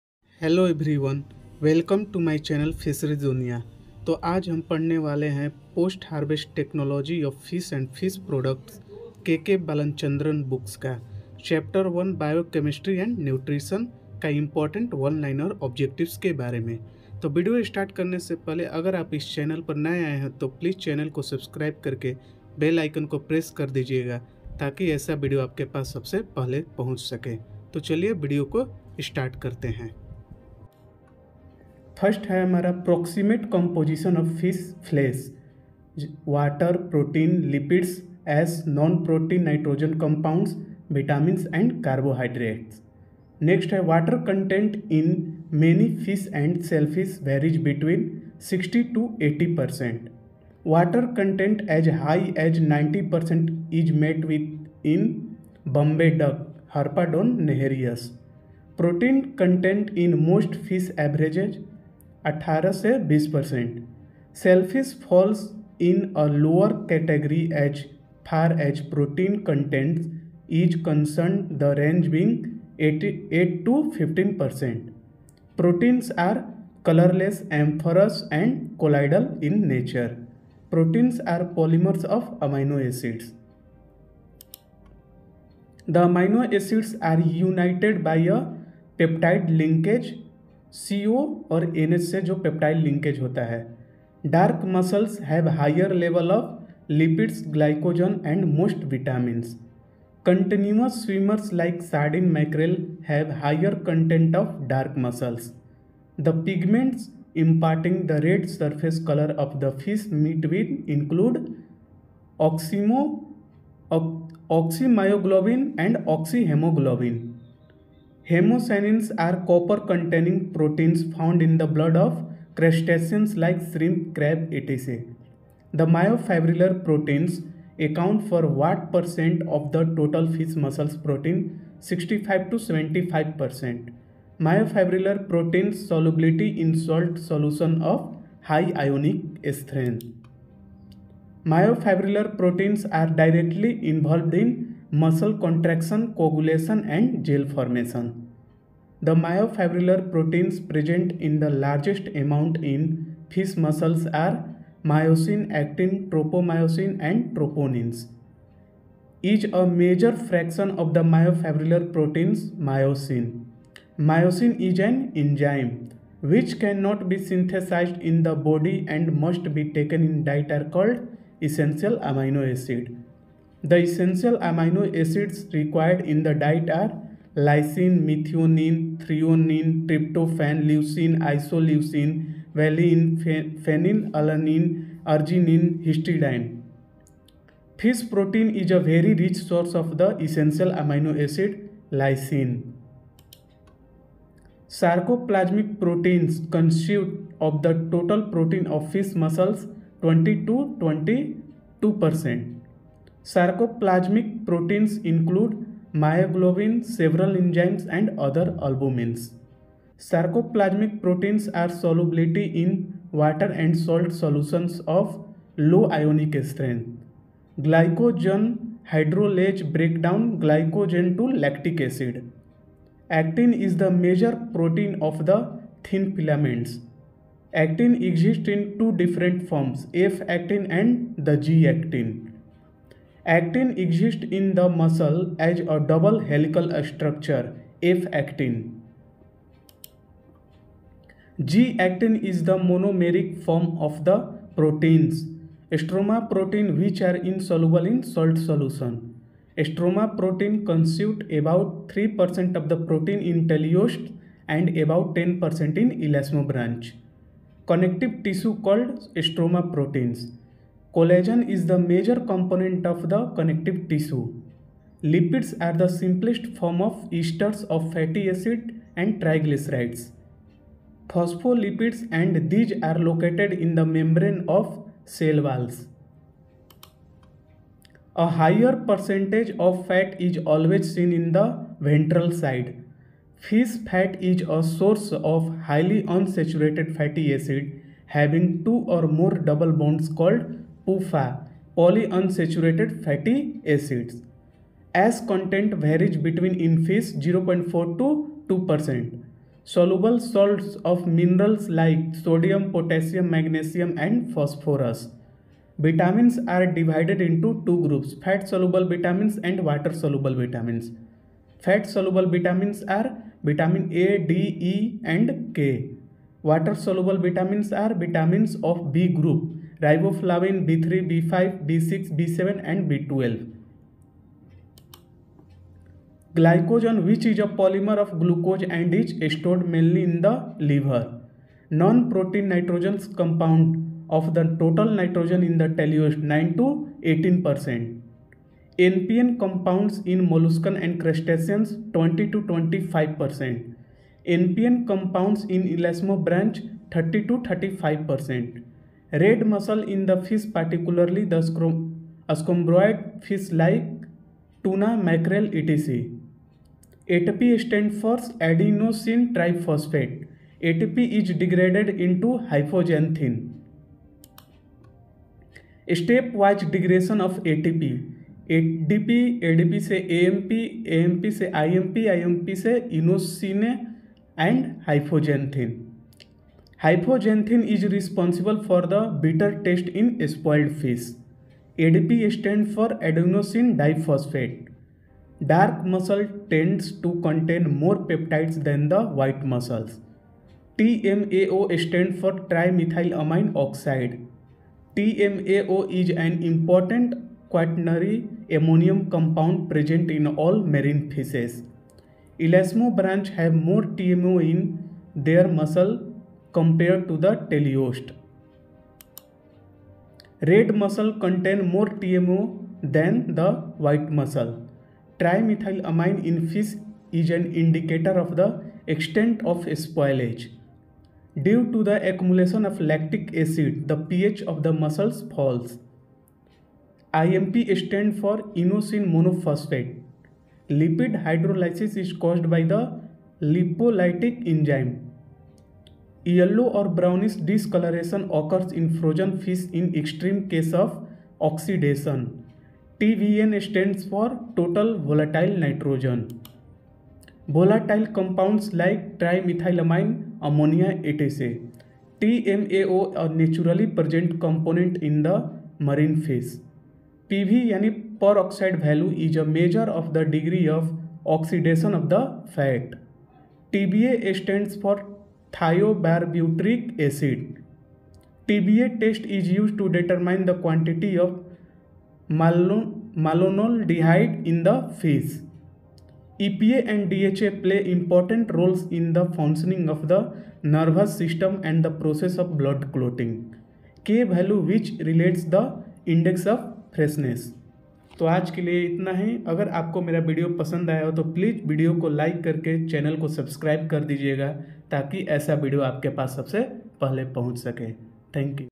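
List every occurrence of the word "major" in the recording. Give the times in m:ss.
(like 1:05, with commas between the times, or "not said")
2:39, 3:43, 4:21.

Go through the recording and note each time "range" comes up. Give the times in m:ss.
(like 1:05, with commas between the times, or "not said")
1:11.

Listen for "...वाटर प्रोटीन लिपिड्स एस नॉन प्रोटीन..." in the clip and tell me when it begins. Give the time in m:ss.
0:36.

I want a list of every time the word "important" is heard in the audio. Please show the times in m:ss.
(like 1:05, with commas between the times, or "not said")
6:36, 7:57.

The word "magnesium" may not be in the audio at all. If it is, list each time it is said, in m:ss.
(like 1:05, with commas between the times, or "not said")
5:03.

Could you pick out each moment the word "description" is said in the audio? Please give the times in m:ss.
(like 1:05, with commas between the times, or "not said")
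not said.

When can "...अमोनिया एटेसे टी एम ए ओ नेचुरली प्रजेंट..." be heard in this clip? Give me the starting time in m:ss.
7:30.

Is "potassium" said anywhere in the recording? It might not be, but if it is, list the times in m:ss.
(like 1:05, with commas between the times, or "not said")
5:02.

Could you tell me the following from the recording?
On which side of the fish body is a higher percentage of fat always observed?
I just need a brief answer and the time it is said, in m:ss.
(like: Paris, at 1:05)
Ventral side, at 4:41.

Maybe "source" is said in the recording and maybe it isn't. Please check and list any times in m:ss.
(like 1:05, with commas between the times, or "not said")
3:09, 4:44.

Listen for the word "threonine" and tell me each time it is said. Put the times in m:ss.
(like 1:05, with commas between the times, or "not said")
2:58.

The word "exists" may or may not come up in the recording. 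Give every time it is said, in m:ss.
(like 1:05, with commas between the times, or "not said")
3:48, 3:53.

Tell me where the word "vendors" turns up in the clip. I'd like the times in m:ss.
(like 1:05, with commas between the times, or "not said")
not said.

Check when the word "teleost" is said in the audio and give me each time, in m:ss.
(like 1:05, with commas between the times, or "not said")
4:13, 5:35.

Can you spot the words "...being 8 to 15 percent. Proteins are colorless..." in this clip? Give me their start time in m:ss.
1:12.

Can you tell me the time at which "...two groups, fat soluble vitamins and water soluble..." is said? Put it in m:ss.
5:07.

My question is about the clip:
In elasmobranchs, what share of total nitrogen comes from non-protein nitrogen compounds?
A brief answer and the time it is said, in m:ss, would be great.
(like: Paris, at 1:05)
30 to 35%, at 5:46.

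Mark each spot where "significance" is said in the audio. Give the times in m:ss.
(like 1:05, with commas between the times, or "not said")
not said.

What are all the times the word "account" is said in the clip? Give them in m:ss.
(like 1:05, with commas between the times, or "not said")
2:07.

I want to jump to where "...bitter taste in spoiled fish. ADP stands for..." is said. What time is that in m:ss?
6:19.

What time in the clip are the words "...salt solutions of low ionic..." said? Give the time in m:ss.
3:33.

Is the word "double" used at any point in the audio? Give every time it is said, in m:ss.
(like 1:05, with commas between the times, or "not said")
3:55, 4:49.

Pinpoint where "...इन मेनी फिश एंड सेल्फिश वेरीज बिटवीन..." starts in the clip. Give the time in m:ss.
0:44.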